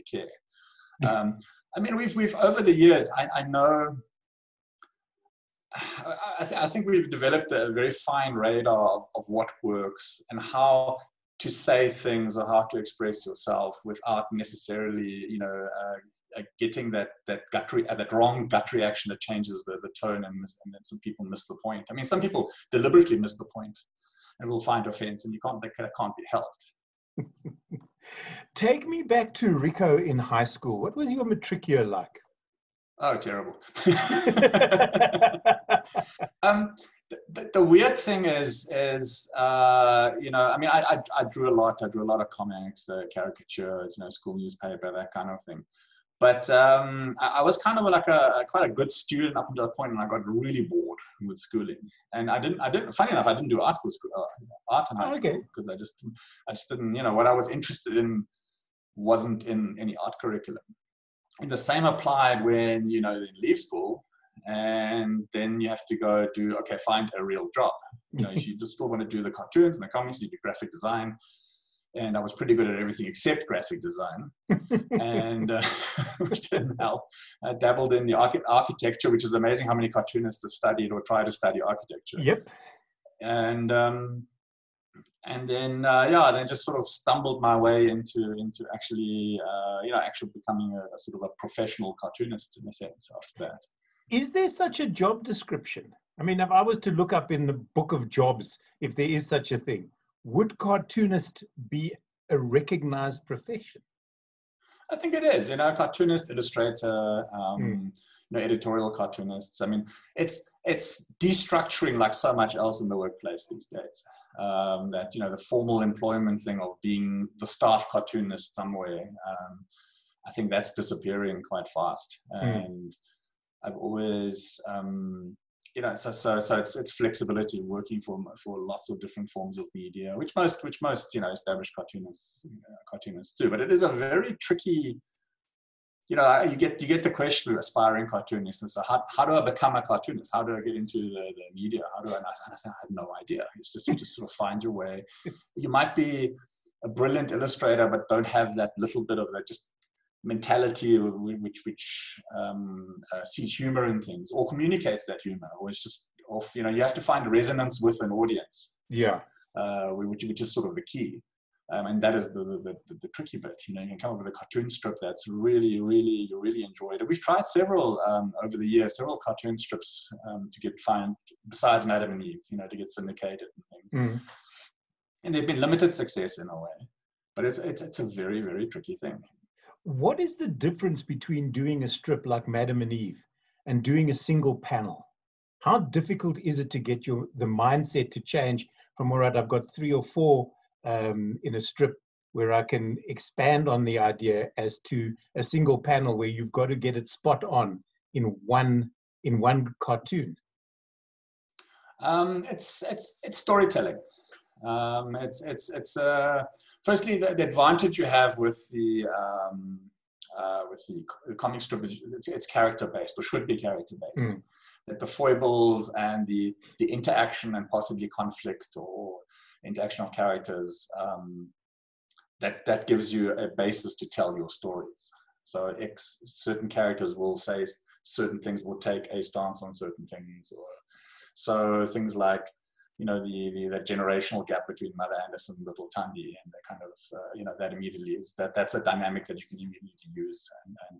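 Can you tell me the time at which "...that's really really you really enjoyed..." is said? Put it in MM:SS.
02:45.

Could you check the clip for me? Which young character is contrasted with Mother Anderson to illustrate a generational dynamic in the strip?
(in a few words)
Little Thandi.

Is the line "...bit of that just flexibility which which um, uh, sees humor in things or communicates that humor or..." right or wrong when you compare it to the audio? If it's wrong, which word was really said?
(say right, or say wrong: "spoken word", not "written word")
wrong: "mentality", not "flexibility".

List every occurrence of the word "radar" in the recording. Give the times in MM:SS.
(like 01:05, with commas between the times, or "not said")
00:08.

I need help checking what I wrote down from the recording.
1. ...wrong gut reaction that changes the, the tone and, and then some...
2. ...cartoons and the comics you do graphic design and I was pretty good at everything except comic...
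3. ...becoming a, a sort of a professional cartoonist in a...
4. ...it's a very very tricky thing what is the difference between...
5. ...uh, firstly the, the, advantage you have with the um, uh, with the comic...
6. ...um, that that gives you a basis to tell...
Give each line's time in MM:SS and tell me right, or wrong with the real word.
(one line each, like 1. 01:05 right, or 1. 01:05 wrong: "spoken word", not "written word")
1. 00:18 right
2. 01:09 wrong: "graphic", not "comic"
3. 01:30 right
4. 02:57 right
5. 03:25 right
6. 03:40 right.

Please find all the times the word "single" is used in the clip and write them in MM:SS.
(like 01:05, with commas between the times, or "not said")
03:04, 03:15.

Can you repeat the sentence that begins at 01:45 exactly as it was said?
You know, cartoonist, illustrator, um, mm.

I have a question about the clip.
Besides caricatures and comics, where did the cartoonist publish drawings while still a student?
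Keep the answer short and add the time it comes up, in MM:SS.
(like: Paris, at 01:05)
School newspaper, at 00:44.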